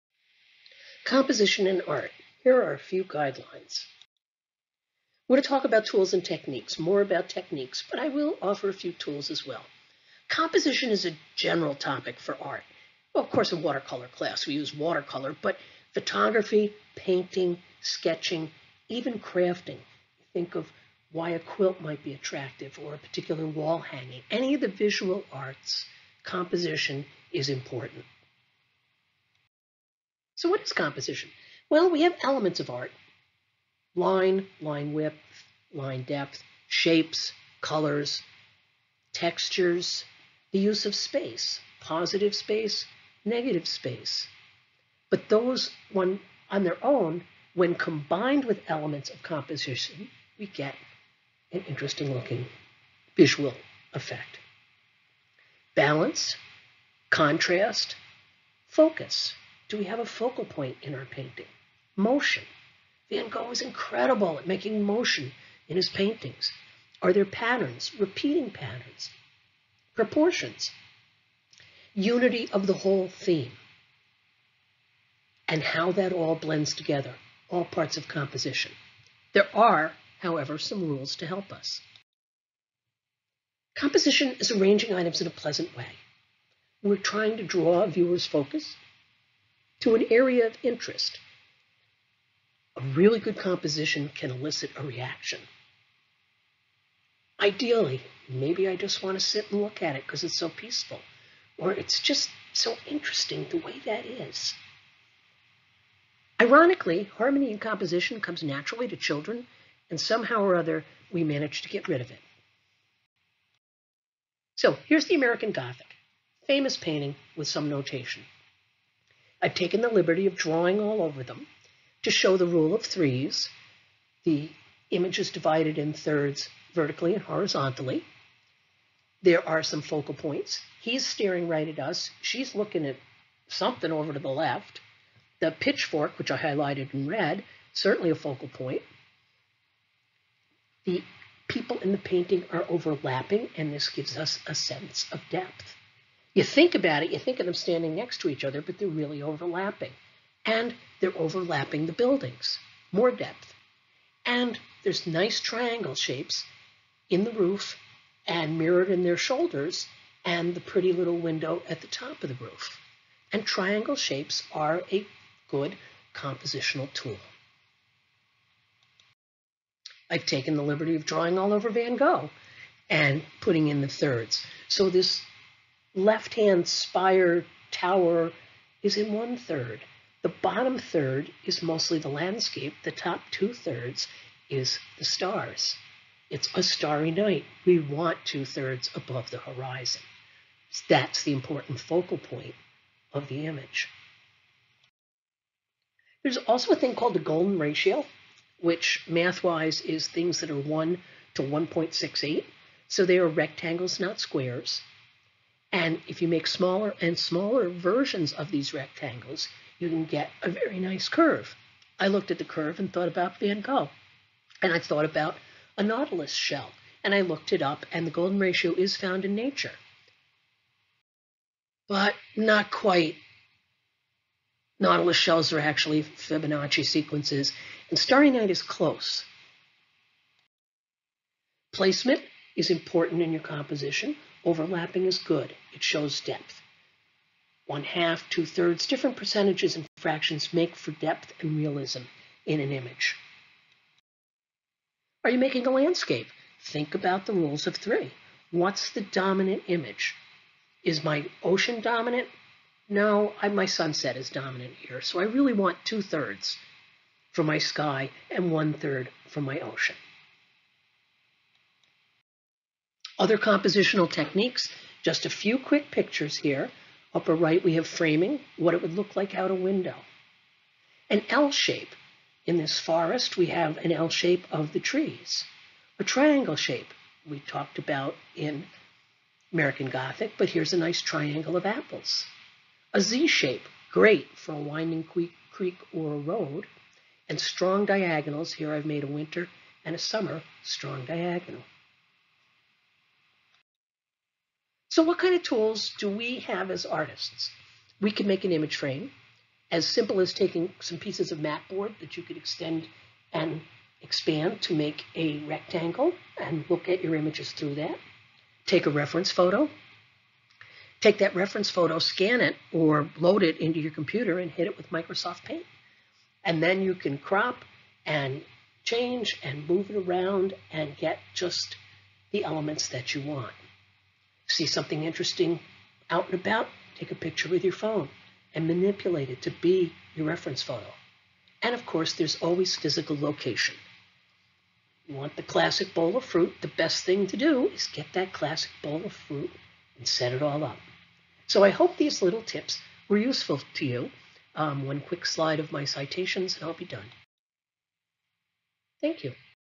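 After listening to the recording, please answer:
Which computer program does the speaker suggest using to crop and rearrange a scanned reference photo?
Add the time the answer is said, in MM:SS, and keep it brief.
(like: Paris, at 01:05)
Microsoft Paint, at 05:14.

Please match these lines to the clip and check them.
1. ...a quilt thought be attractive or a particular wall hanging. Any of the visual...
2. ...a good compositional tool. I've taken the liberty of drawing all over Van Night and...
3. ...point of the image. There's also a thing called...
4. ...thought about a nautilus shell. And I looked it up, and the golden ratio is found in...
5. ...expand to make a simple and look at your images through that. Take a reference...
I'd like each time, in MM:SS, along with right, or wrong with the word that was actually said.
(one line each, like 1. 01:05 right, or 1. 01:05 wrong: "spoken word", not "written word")
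1. 00:21 wrong: "might", not "thought"
2. 02:44 wrong: "Gogh", not "Night"
3. 03:12 right
4. 03:34 right
5. 05:04 wrong: "rectangle", not "simple".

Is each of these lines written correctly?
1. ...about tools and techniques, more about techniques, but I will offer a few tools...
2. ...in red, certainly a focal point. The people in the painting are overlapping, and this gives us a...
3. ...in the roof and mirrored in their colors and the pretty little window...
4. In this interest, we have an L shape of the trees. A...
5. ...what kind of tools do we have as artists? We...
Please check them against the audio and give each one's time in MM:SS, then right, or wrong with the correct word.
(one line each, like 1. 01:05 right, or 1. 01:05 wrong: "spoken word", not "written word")
1. 00:05 right
2. 02:16 right
3. 02:37 wrong: "shoulders", not "colors"
4. 04:32 wrong: "forest", not "interest"
5. 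04:55 right.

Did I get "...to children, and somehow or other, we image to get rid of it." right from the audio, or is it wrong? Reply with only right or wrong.
wrong.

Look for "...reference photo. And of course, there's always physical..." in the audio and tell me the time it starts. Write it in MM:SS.
05:30.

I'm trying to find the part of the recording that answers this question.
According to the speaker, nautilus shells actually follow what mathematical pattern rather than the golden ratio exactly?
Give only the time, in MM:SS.
03:46.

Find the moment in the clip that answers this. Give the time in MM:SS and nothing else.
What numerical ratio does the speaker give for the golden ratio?
03:20.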